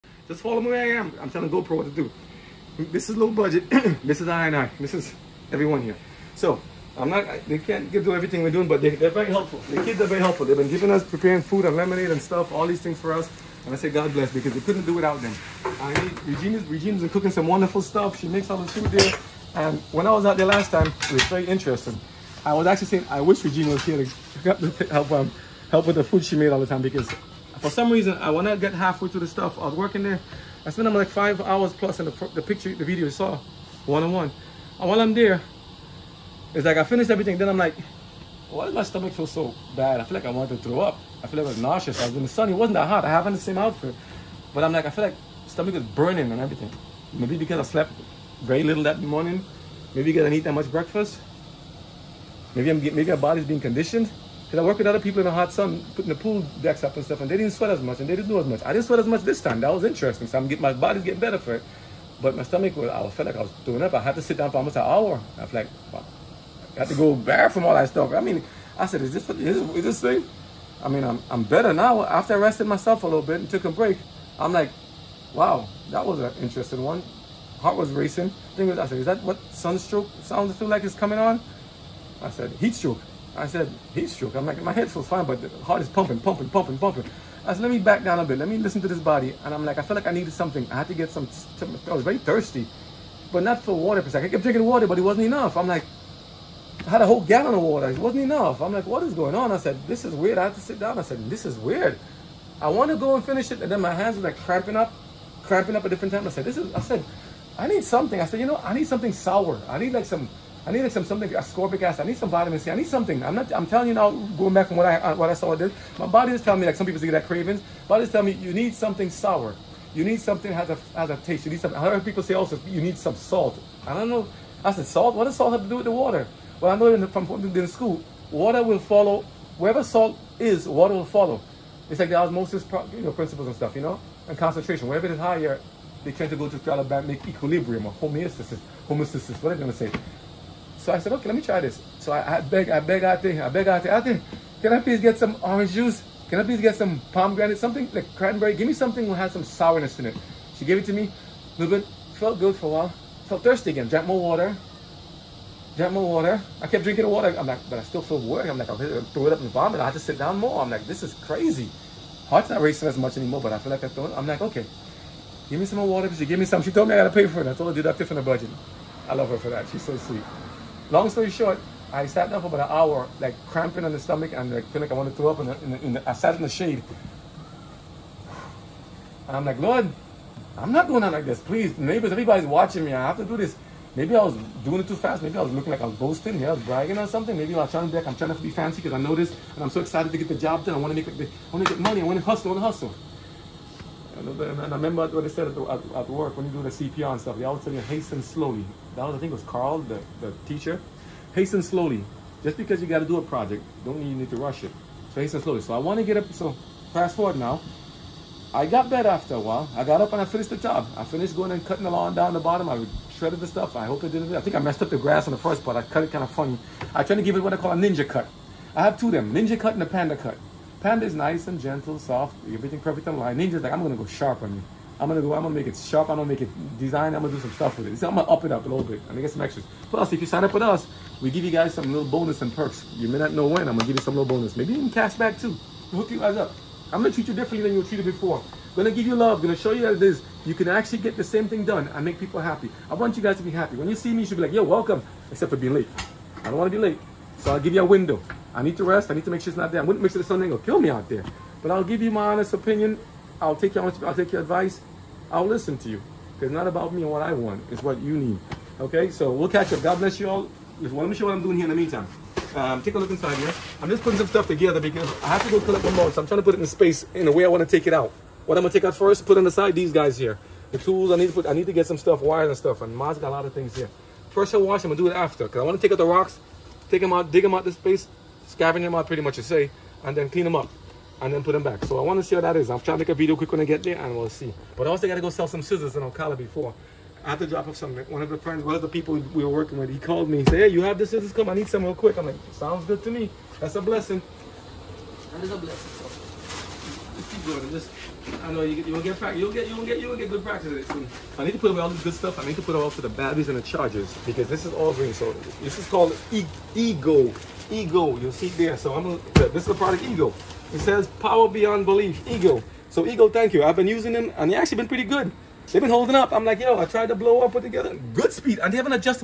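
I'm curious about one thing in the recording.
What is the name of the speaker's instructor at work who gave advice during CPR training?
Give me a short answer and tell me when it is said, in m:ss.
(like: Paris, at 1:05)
Carl, at 3:19.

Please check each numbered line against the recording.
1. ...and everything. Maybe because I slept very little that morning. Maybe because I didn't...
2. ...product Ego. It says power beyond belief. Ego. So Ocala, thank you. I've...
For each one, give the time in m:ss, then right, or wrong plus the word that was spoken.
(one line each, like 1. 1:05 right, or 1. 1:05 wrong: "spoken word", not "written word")
1. 0:46 right
2. 5:09 wrong: "Ego", not "Ocala".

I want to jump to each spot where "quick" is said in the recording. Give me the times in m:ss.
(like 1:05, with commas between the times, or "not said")
4:43, 4:51.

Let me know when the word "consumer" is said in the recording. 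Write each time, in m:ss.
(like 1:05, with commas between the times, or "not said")
not said.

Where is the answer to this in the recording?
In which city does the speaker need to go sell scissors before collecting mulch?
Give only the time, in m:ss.
4:46.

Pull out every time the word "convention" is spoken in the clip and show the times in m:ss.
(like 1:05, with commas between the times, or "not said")
not said.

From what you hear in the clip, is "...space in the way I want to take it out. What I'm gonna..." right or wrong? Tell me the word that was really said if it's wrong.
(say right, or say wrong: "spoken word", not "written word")
right.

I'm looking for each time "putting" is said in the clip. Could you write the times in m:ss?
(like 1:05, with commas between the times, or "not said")
0:55, 4:24.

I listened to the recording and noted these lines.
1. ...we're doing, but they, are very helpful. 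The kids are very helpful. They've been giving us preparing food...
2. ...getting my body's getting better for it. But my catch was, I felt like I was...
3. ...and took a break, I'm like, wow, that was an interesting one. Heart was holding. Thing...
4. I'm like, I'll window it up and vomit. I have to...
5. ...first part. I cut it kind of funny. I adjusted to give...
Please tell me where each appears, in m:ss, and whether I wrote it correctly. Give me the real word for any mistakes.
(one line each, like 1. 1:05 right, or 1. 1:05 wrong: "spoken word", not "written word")
1. 0:08 right
2. 1:00 wrong: "stomach", not "catch"
3. 1:13 wrong: "racing", not "holding"
4. 2:38 wrong: "throw", not "window"
5. 3:35 wrong: "tried", not "adjusted".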